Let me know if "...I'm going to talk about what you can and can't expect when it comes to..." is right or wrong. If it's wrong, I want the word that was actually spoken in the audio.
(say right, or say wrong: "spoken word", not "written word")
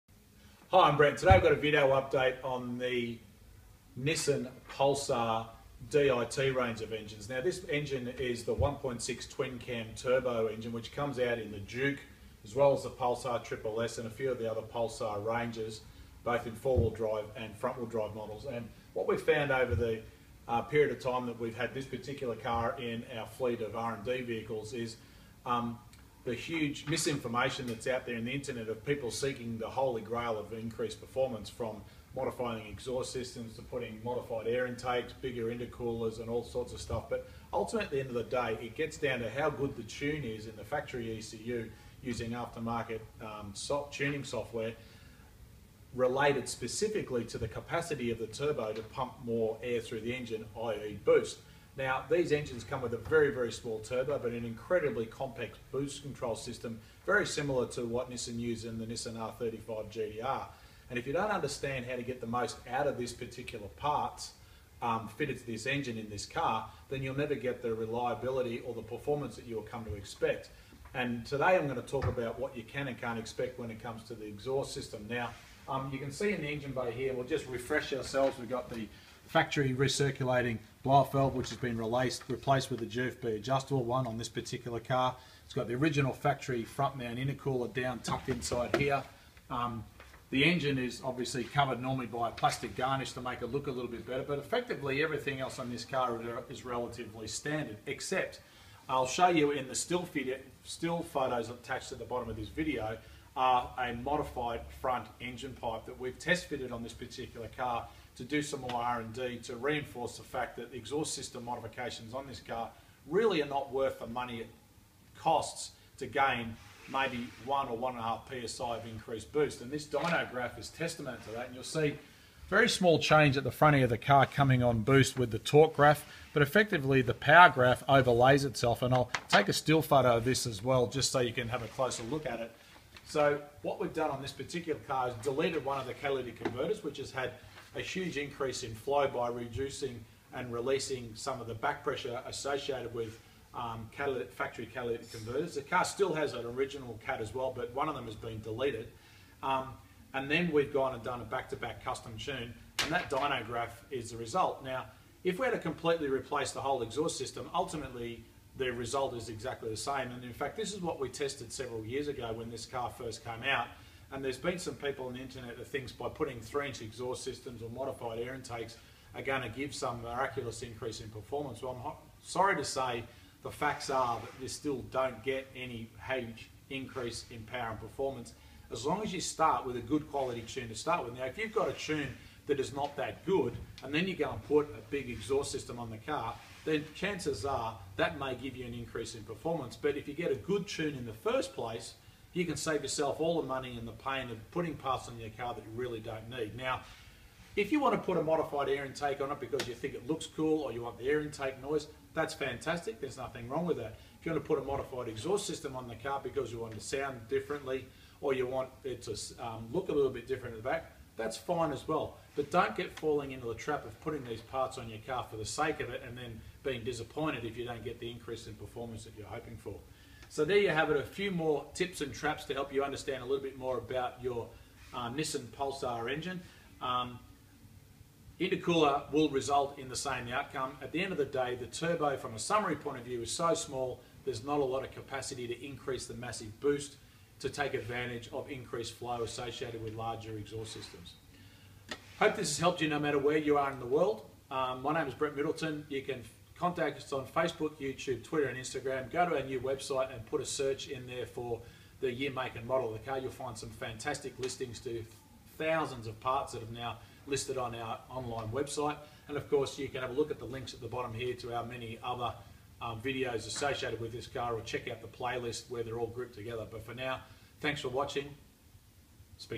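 right.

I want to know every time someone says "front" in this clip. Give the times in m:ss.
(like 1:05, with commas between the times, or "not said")
0:17, 1:26, 1:44, 2:03.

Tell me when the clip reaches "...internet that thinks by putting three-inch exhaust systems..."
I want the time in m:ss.
2:45.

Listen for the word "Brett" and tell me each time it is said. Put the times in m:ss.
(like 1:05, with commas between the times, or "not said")
0:00, 4:05.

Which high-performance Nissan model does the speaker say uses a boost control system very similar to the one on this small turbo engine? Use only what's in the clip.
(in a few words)
Nissan R35 GTR.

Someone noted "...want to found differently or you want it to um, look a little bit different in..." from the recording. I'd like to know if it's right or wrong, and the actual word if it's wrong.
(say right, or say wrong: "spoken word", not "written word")
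wrong: "sound", not "found".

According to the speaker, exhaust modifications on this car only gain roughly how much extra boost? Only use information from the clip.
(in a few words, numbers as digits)
1 or 1.5 psi.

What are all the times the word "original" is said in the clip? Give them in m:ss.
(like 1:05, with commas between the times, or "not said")
1:25, 2:26.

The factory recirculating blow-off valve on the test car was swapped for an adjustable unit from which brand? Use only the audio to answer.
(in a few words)
GFB.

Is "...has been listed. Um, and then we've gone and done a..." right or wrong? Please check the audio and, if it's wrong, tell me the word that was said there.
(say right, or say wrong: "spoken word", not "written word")
wrong: "deleted", not "listed".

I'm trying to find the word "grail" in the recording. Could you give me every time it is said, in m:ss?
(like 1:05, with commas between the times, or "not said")
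0:30.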